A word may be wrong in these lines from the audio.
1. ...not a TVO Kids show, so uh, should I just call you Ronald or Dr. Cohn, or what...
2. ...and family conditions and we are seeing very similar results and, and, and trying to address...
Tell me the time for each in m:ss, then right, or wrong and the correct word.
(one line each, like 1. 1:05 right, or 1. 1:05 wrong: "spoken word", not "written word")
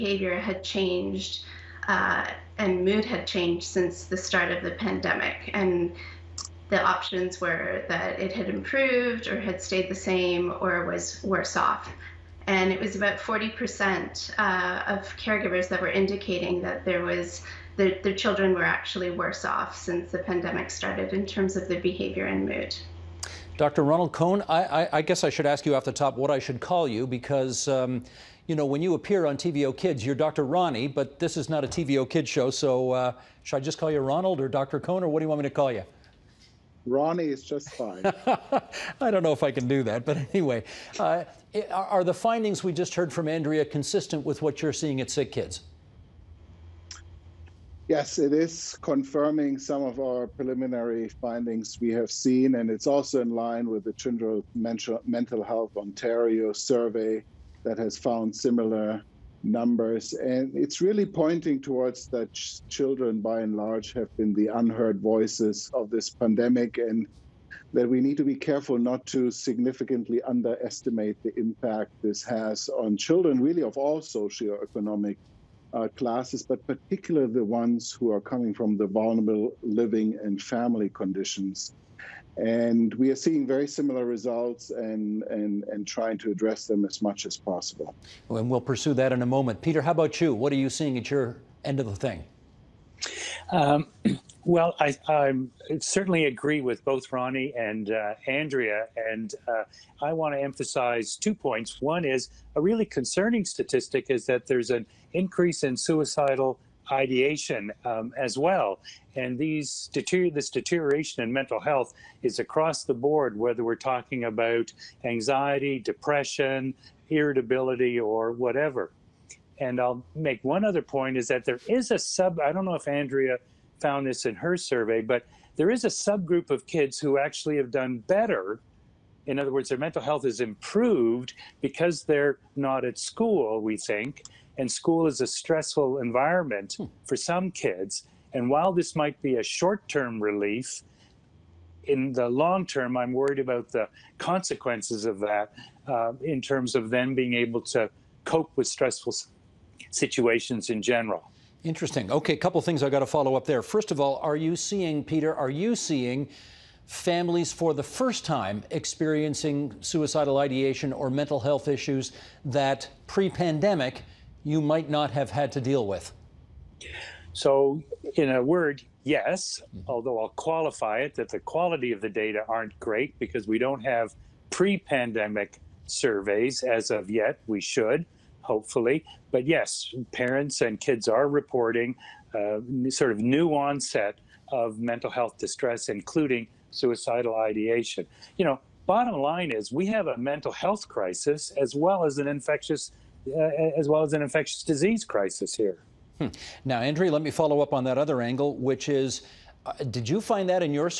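1. 0:31 right
2. 1:20 right.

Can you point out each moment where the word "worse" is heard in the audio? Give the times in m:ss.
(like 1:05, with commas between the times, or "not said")
0:11, 0:19.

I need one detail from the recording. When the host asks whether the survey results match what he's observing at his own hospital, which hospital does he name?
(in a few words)
Sick Kids.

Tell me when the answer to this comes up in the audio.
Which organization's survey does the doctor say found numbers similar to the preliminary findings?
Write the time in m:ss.
0:53.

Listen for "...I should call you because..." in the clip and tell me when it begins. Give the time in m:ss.
0:26.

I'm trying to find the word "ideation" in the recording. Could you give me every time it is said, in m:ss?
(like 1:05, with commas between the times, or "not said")
1:46, 2:40, 3:07.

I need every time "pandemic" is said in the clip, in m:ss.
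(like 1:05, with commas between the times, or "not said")
0:04, 0:20, 1:06, 2:43, 2:54.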